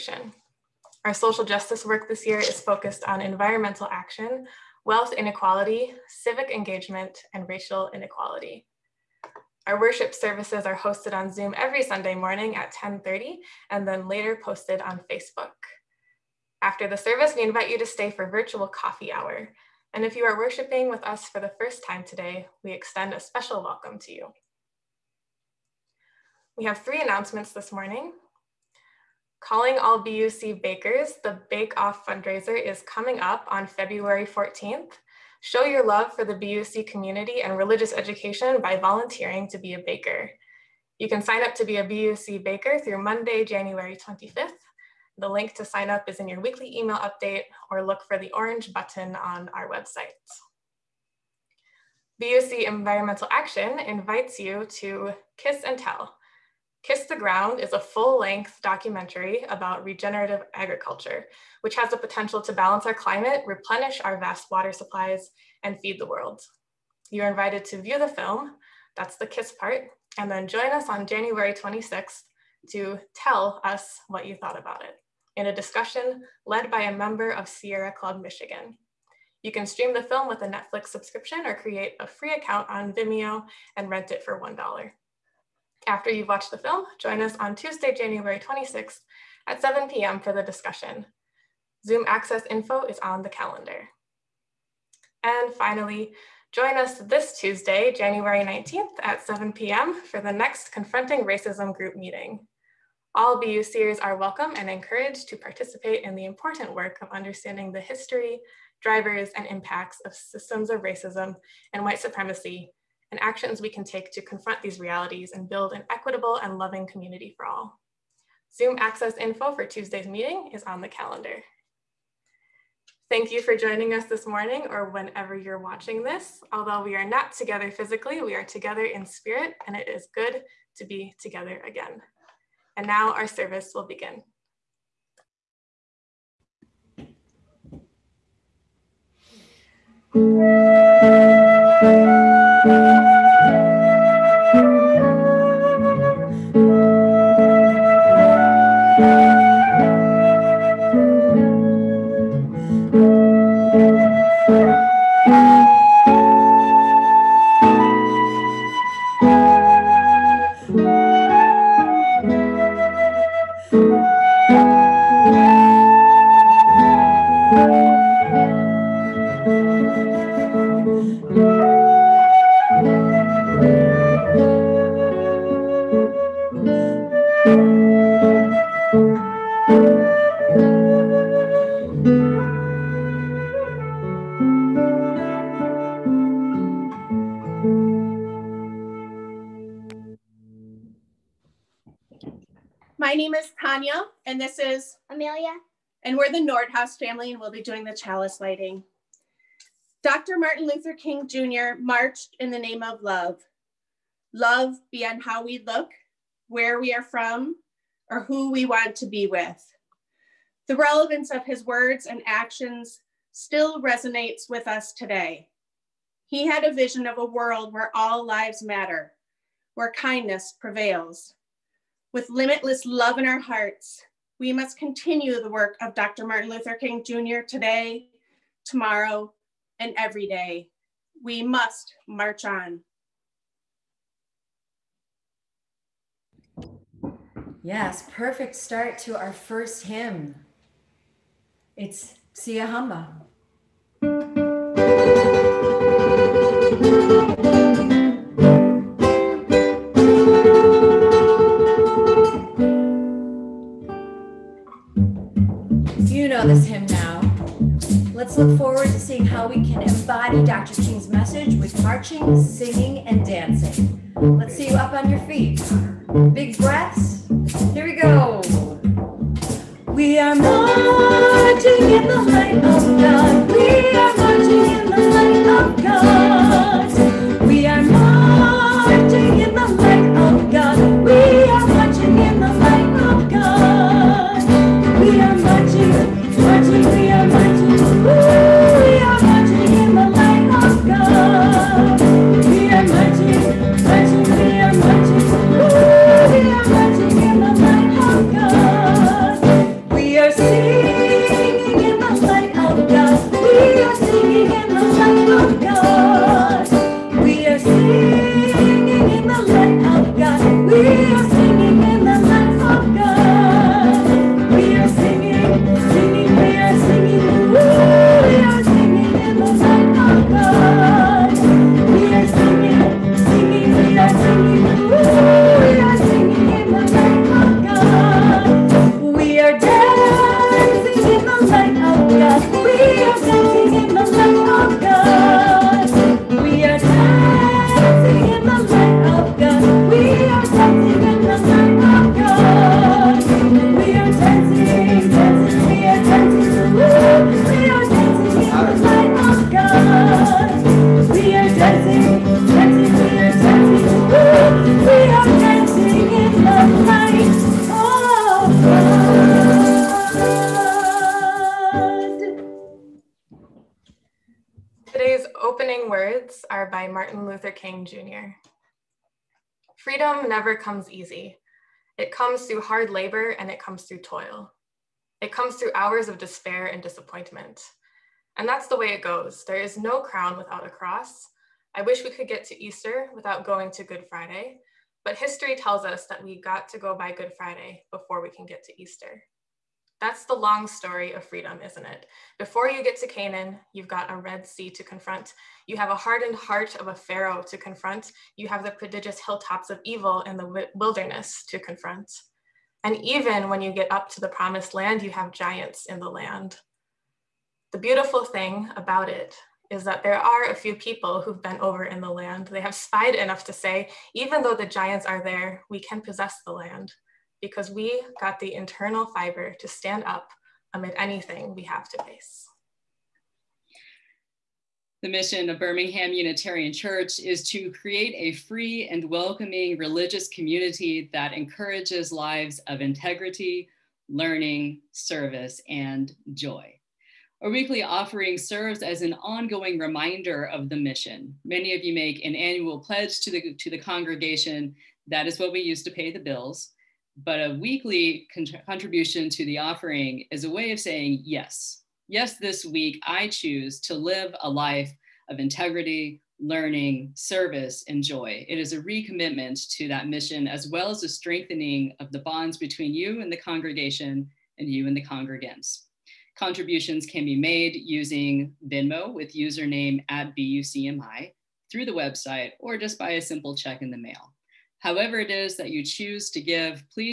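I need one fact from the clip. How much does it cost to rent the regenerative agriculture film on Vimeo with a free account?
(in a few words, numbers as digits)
$1.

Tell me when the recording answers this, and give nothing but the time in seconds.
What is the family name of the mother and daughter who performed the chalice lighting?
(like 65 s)
196 s.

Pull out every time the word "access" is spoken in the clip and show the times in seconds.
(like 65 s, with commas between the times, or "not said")
92 s, 118 s.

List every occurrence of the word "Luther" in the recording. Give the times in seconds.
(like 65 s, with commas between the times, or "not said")
200 s, 226 s.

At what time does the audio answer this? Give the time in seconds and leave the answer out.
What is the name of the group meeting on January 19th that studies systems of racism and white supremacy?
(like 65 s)
100 s.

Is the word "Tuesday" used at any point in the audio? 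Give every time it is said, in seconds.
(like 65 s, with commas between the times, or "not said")
87 s, 97 s, 119 s.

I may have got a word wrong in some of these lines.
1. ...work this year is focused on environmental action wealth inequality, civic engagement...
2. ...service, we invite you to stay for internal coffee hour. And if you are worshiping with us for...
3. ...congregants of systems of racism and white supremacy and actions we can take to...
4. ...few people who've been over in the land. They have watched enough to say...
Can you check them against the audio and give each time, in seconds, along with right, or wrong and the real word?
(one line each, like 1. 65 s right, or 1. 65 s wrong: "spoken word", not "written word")
1. 1 s right
2. 16 s wrong: "virtual", not "internal"
3. 109 s wrong: "impacts", not "congregants"
4. 410 s wrong: "spied", not "watched".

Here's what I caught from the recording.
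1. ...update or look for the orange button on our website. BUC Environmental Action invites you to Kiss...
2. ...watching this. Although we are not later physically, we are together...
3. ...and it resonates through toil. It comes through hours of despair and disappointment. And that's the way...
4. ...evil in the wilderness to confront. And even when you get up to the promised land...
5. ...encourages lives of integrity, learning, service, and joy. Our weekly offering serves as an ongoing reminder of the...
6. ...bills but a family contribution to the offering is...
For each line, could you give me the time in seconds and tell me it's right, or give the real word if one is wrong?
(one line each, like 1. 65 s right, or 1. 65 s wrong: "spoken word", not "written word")
1. 46 s right
2. 125 s wrong: "together", not "later"
3. 373 s wrong: "comes", not "resonates"
4. 399 s right
5. 431 s right
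6. 446 s wrong: "weekly", not "family".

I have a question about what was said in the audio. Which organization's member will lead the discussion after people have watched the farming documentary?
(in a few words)
Sierra Club Michigan.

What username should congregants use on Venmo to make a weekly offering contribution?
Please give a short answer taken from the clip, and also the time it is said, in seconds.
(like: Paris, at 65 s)
BUCMI, at 470 s.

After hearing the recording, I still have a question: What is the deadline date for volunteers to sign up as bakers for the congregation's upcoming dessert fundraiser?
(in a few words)
Monday, January 25th.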